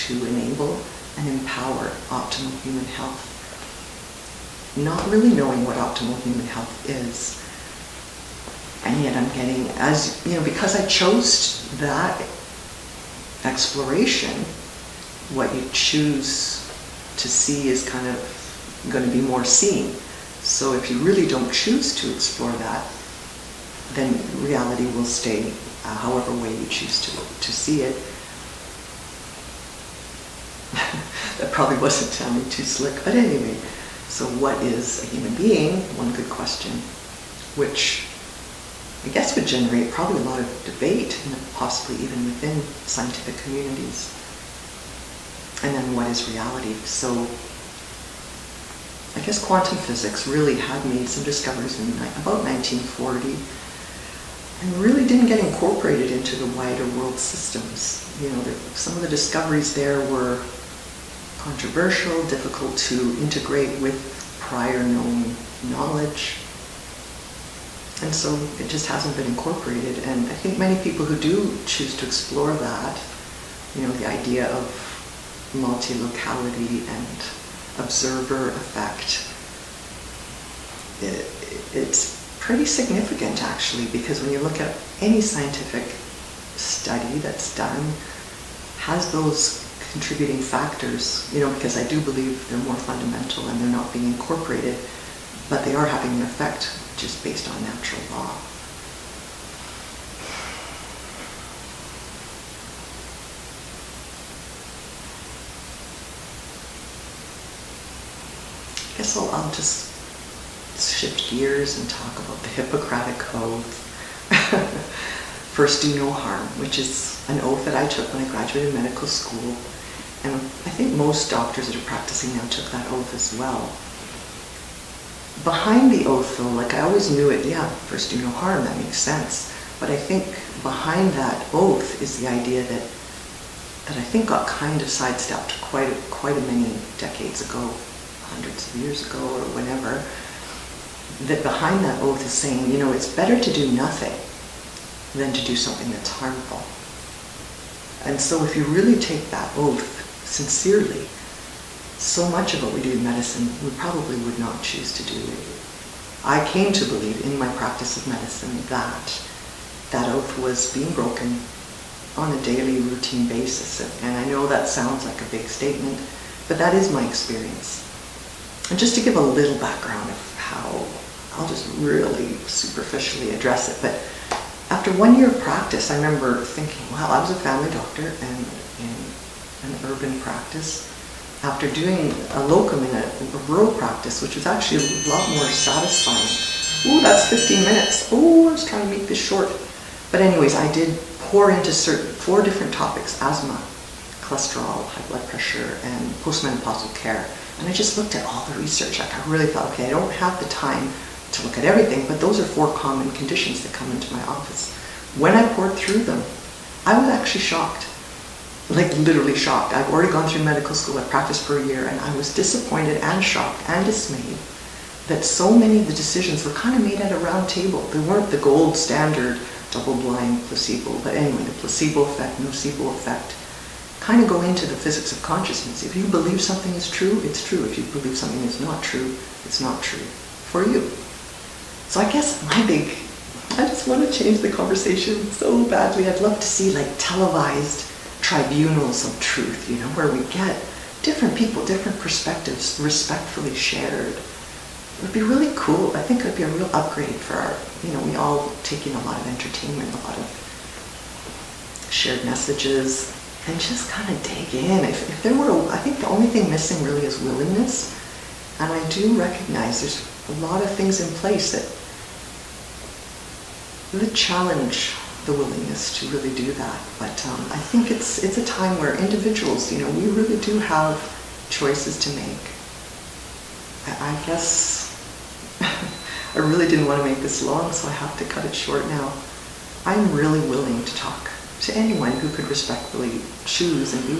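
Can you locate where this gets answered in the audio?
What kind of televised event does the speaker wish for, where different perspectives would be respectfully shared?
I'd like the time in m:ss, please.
3:58.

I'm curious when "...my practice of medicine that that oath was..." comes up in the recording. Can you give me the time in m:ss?
2:37.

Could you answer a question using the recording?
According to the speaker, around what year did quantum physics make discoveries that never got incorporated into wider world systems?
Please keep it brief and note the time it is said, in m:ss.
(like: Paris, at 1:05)
1940, at 0:52.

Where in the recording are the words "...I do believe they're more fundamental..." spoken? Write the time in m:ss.
1:31.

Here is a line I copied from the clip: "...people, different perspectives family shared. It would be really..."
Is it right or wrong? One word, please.
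wrong.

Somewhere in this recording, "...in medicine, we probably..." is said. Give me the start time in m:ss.
2:32.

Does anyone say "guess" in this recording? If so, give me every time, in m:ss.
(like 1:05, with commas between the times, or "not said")
0:39, 0:49, 1:48, 3:52, 4:34.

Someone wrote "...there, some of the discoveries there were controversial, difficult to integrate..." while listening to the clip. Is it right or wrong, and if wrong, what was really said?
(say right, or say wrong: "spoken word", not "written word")
right.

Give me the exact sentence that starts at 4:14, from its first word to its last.
If, if there were, I think the only thing missing really is willingness.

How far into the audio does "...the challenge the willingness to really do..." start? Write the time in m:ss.
4:23.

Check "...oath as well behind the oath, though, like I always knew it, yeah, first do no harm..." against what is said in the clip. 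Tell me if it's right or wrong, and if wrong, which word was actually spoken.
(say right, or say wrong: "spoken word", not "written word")
right.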